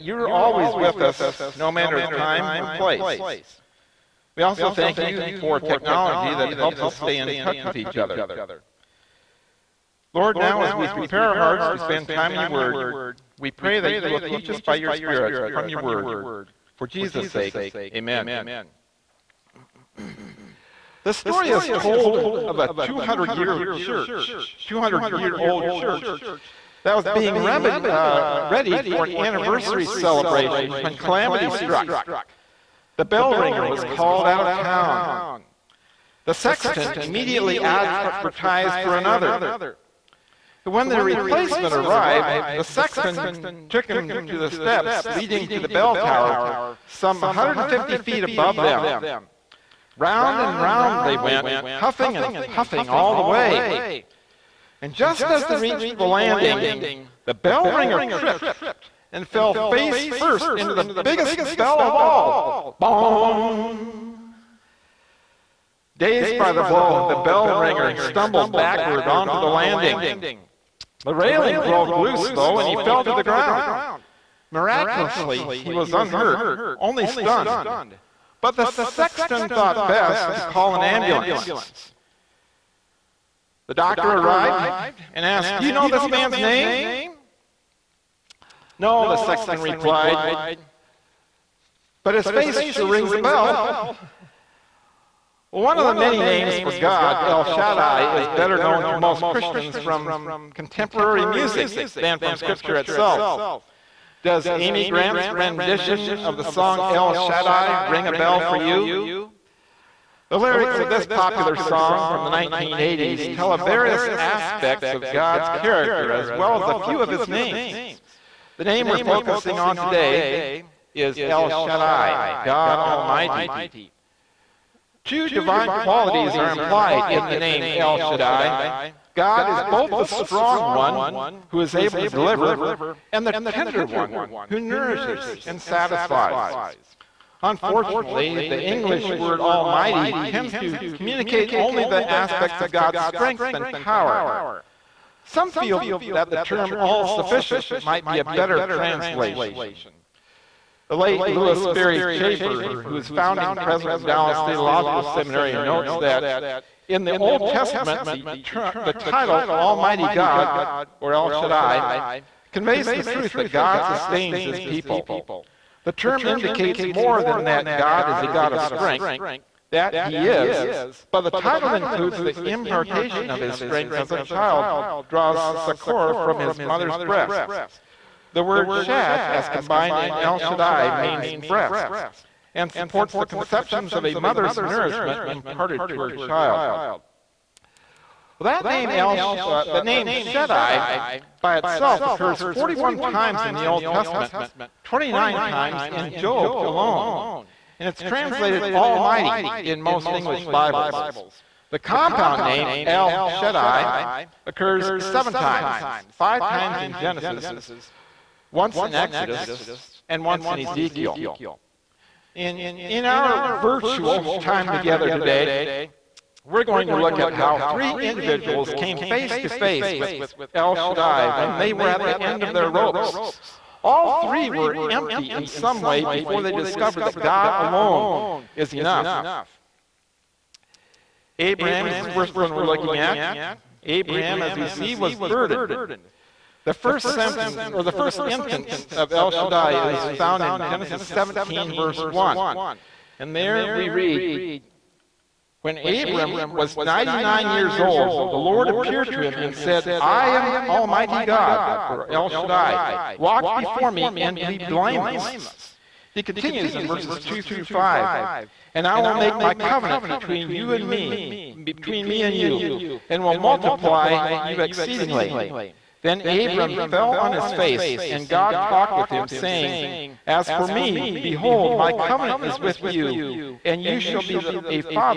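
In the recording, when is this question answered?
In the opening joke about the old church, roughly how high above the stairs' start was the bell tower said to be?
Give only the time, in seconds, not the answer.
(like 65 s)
47 s.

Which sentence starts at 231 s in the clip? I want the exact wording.
Abraham is the first one we're looking at.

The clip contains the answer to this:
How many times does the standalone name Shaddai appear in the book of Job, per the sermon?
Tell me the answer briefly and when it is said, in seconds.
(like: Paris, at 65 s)
29, at 194 s.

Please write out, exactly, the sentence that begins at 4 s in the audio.
We also thank you for technology that helps us stay in touch with each other.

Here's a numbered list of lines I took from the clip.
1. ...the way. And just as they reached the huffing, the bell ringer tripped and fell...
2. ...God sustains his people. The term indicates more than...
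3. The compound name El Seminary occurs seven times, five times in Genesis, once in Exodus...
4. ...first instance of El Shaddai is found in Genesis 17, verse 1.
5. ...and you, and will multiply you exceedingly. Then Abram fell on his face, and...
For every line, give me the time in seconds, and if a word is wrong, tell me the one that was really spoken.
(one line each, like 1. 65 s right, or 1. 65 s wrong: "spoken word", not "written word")
1. 53 s wrong: "landing", not "huffing"
2. 163 s right
3. 201 s wrong: "Shaddai", not "Seminary"
4. 237 s right
5. 262 s right.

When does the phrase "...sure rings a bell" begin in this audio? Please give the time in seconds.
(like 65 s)
92 s.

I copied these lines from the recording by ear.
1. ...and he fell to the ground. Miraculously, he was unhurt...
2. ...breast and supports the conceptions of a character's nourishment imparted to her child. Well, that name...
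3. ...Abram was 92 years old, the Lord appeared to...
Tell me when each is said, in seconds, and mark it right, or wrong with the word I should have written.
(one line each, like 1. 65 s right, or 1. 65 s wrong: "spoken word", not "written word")
1. 72 s right
2. 181 s wrong: "mother", not "character"
3. 245 s wrong: "99", not "92".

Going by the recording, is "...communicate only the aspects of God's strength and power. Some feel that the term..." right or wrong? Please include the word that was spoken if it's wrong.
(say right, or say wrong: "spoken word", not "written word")
right.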